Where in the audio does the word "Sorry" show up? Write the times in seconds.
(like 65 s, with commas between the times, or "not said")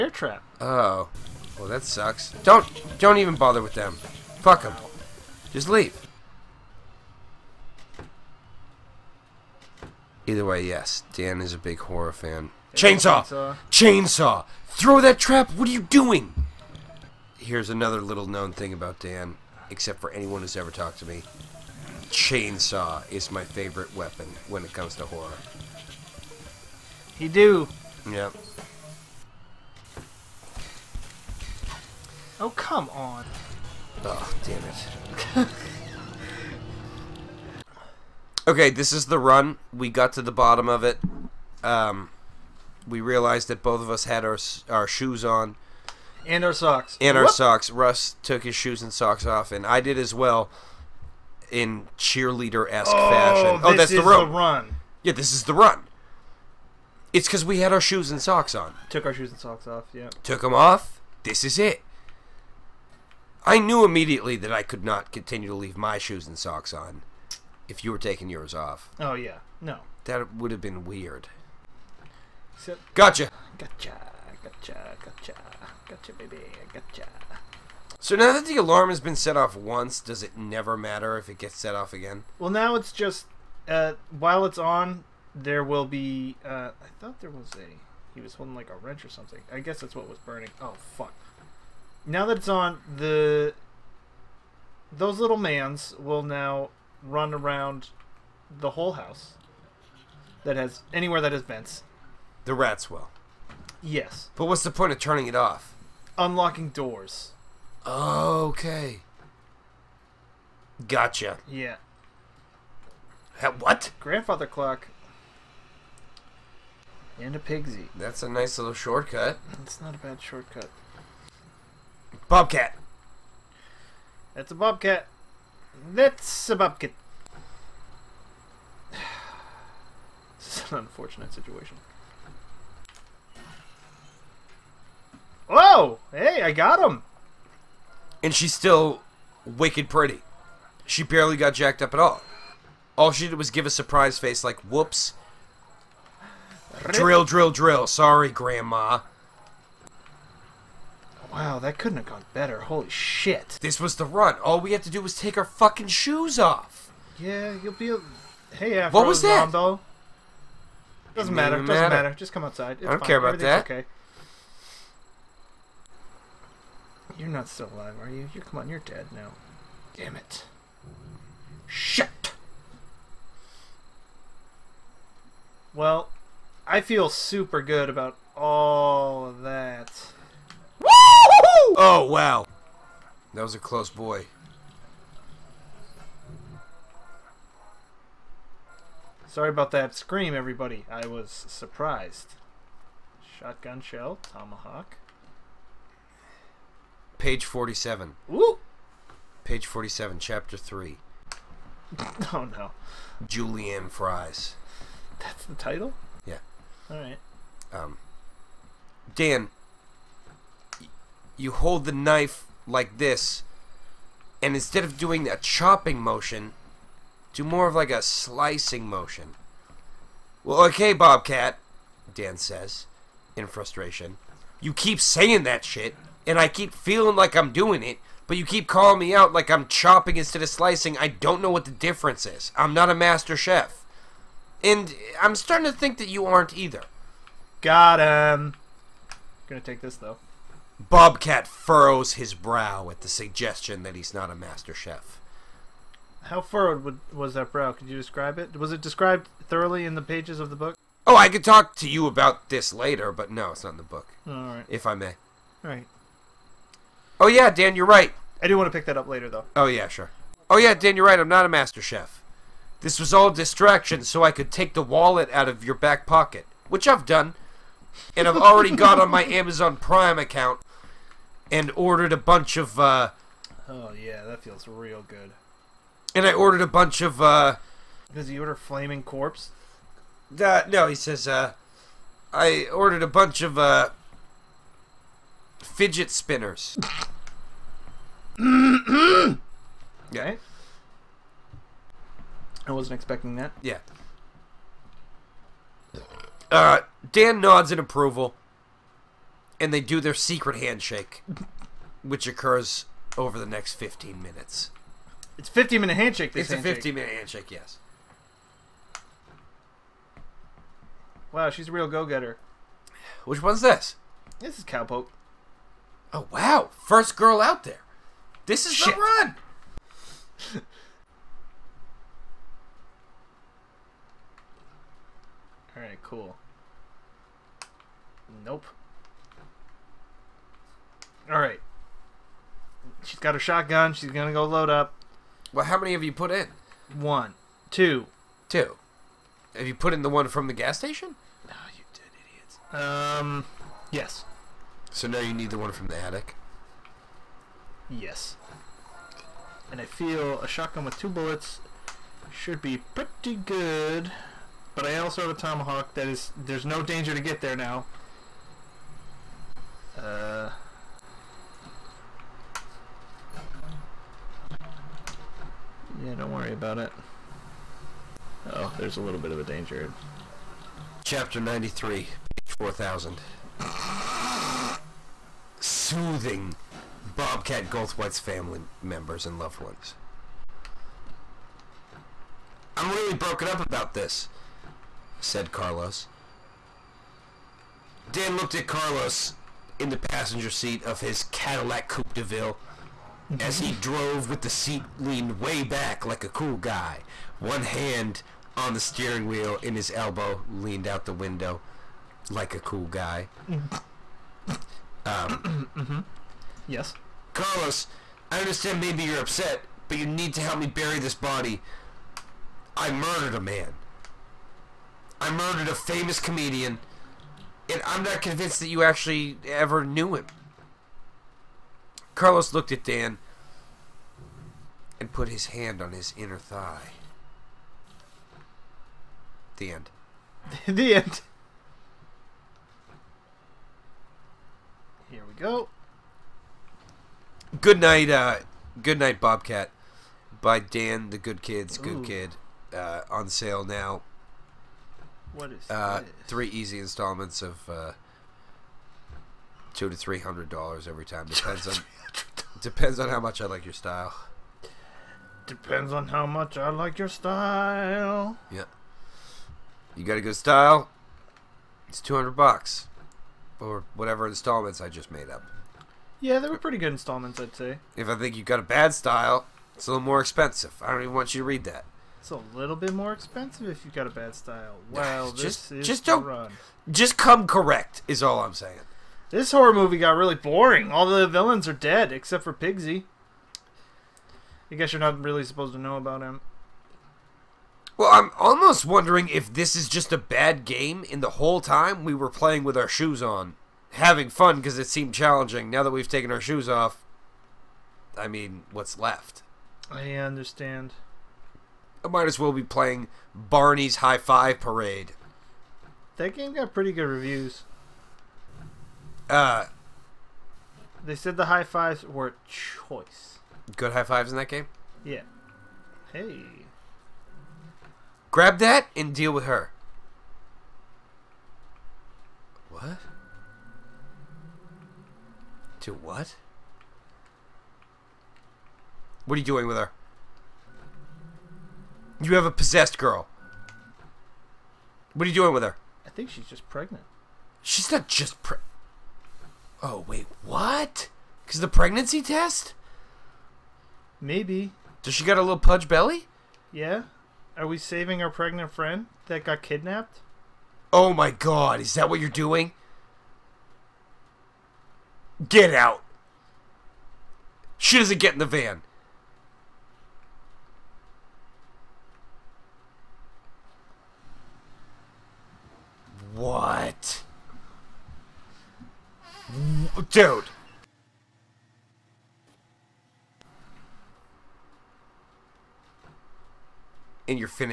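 147 s, 189 s.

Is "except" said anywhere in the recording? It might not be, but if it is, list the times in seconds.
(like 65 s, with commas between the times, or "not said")
19 s, 482 s.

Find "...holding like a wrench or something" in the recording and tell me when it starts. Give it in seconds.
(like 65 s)
88 s.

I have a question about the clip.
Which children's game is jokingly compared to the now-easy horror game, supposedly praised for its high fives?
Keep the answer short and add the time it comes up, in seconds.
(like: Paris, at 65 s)
Barney's High Five Parade, at 503 s.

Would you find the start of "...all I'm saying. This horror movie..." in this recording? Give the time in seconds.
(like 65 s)
478 s.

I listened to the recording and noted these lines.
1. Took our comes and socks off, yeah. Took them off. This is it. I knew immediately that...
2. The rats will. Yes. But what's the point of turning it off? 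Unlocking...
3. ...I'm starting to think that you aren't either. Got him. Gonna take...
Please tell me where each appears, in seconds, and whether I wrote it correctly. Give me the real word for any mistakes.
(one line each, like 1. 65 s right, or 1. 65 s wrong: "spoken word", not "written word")
1. 58 s wrong: "shoes", not "comes"
2. 102 s right
3. 235 s right.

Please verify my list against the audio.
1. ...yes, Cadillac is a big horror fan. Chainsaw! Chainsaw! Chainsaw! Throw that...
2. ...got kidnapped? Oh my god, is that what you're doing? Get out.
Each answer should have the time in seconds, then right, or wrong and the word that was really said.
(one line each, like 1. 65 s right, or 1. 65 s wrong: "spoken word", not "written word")
1. 10 s wrong: "Dan", not "Cadillac"
2. 549 s right.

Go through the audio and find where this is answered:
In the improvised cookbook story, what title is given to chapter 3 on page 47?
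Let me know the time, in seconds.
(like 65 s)
203 s.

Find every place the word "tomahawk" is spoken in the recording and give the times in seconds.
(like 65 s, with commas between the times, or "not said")
194 s, 355 s.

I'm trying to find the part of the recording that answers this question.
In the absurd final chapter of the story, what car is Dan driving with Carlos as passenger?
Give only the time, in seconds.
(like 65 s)
391 s.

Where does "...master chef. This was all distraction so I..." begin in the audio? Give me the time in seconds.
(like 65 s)
261 s.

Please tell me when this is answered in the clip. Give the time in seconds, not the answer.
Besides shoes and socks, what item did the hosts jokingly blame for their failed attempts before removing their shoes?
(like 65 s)
47 s.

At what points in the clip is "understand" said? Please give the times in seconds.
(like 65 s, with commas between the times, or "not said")
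408 s, 500 s.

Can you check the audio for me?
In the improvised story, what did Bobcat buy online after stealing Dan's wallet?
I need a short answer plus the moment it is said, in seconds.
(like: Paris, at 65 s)
Fidget spinners, at 285 s.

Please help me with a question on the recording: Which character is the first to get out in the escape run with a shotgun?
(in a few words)
Cowpoke.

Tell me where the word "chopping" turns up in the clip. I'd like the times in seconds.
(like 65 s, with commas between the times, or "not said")
215 s, 229 s.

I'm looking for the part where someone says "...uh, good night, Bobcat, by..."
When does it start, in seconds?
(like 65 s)
438 s.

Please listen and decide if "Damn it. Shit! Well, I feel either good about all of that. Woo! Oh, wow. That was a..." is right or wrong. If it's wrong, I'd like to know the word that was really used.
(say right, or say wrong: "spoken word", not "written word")
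wrong: "super", not "either".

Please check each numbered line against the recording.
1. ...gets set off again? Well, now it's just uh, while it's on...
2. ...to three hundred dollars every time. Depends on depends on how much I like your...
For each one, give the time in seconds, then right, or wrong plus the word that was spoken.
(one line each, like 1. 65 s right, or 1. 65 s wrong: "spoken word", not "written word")
1. 81 s right
2. 449 s right.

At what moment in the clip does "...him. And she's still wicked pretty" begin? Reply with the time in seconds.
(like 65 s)
136 s.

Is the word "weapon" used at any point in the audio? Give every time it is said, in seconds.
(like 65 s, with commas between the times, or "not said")
23 s.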